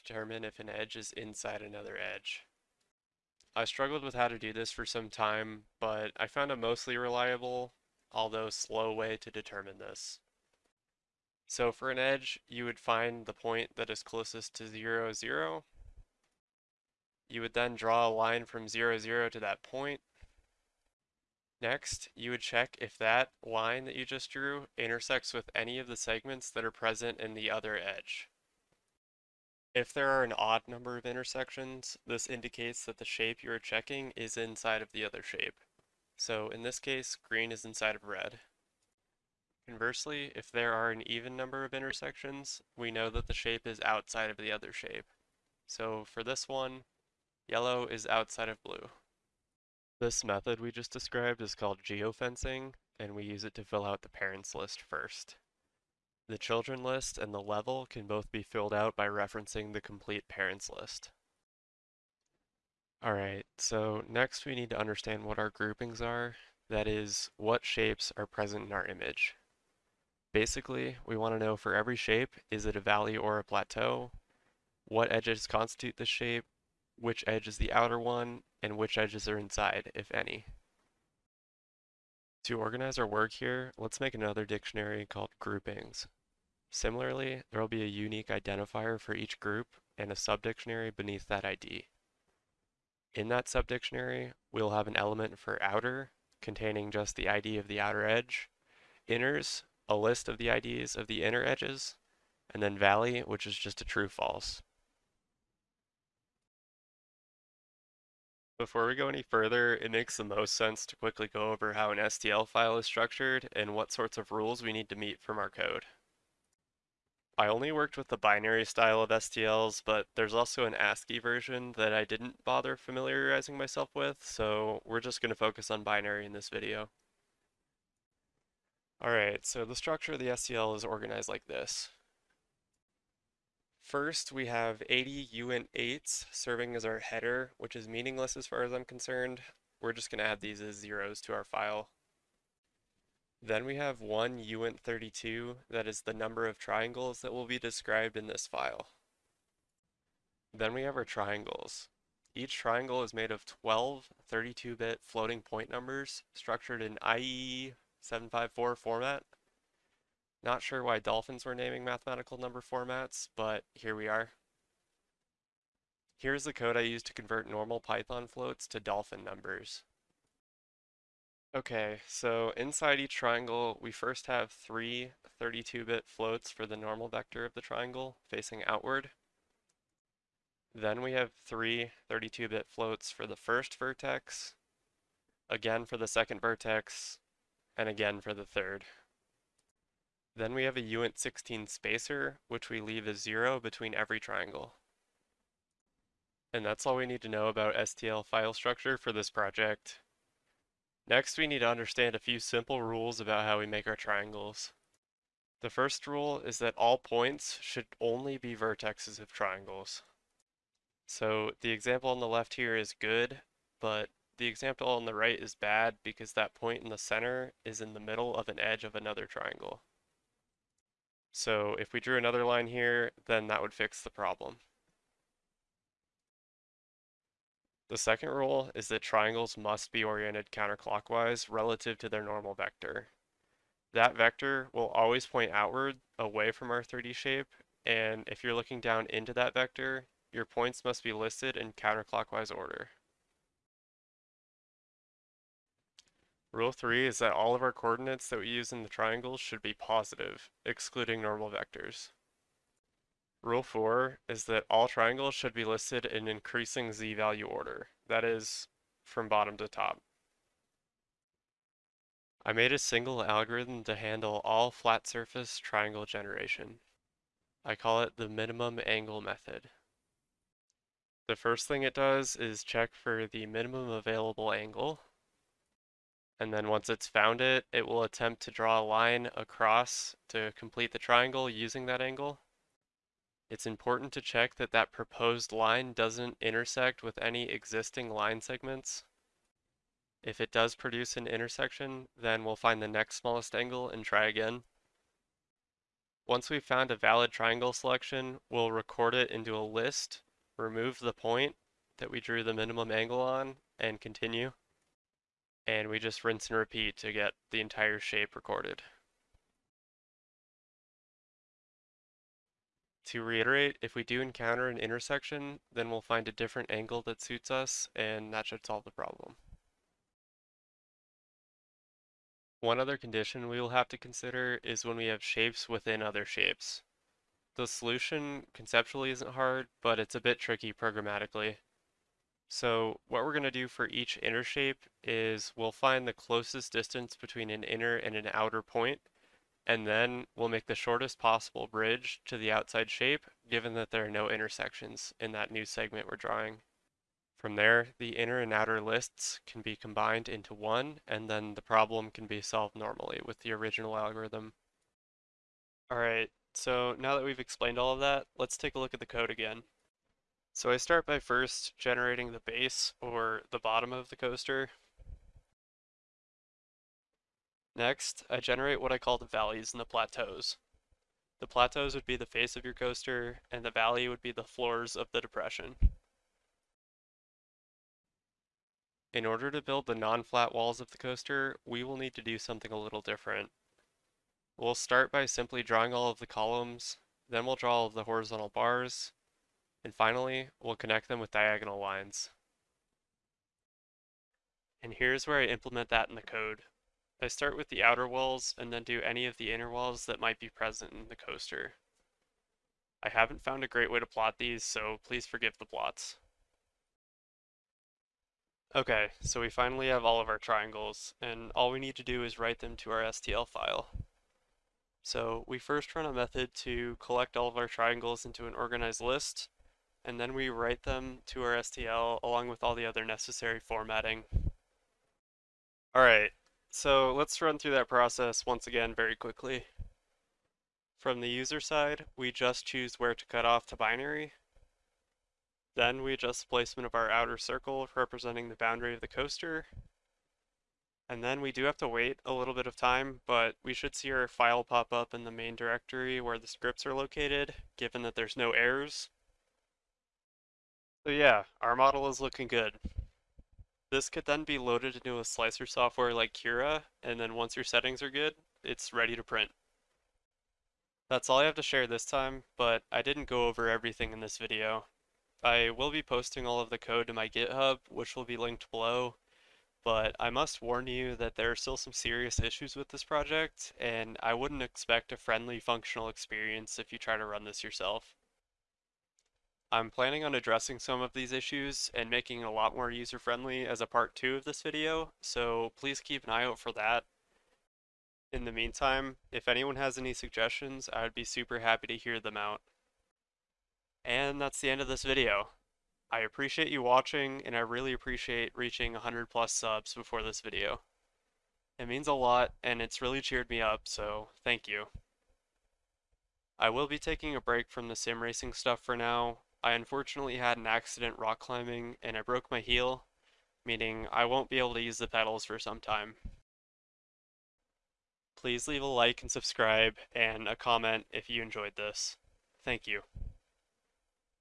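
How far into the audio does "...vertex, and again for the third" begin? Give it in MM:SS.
03:06.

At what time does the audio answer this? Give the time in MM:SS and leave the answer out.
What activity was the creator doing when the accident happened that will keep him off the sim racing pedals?
08:31.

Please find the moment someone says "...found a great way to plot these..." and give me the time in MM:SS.
06:43.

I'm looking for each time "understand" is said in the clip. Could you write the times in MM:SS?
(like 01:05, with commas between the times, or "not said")
01:04, 03:21.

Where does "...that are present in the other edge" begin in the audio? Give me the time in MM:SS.
00:26.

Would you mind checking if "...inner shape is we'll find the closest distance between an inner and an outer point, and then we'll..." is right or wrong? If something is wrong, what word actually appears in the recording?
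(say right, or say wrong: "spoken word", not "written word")
right.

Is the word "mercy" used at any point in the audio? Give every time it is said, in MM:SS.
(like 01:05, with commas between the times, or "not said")
not said.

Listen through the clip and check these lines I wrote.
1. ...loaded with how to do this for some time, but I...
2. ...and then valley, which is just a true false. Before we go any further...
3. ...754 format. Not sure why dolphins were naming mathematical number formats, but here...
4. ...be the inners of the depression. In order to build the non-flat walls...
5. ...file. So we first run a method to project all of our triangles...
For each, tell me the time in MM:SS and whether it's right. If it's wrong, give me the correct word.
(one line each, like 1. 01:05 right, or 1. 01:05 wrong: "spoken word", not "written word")
1. 00:03 wrong: "struggled", not "loaded"
2. 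01:42 right
3. 02:38 right
4. 06:14 wrong: "floors", not "inners"
5. 06:53 wrong: "collect", not "project".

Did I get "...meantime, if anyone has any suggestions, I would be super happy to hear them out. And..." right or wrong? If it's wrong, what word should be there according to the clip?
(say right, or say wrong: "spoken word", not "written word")
right.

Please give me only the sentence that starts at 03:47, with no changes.
The second rule is that triangles must be oriented counterclockwise relative to their normal vector.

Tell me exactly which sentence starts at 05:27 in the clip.
The solution conceptually isn't hard, but it's a bit tricky programmatically.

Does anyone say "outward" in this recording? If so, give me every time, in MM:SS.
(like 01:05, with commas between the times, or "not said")
02:58, 03:55.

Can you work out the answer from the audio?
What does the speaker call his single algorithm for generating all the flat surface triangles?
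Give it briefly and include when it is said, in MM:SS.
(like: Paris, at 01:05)
Minimum angle method, at 04:28.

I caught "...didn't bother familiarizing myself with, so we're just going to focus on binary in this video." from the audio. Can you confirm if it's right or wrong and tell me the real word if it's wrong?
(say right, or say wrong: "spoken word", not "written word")
right.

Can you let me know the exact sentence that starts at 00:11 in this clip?
So for an edge, you would find the point that is closest to 0, 0.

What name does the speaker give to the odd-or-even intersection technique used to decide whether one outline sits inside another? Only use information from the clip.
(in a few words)
Geofencing.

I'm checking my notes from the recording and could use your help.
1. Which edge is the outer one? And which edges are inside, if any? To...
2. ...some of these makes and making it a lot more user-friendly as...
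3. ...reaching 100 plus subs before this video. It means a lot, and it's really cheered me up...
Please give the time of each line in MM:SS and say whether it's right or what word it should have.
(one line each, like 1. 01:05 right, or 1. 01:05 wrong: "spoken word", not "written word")
1. 01:16 right
2. 08:00 wrong: "issues", not "makes"
3. 08:18 right.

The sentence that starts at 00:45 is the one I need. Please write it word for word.
So for this one, yellow is outside of blue.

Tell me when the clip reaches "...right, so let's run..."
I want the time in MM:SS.
07:06.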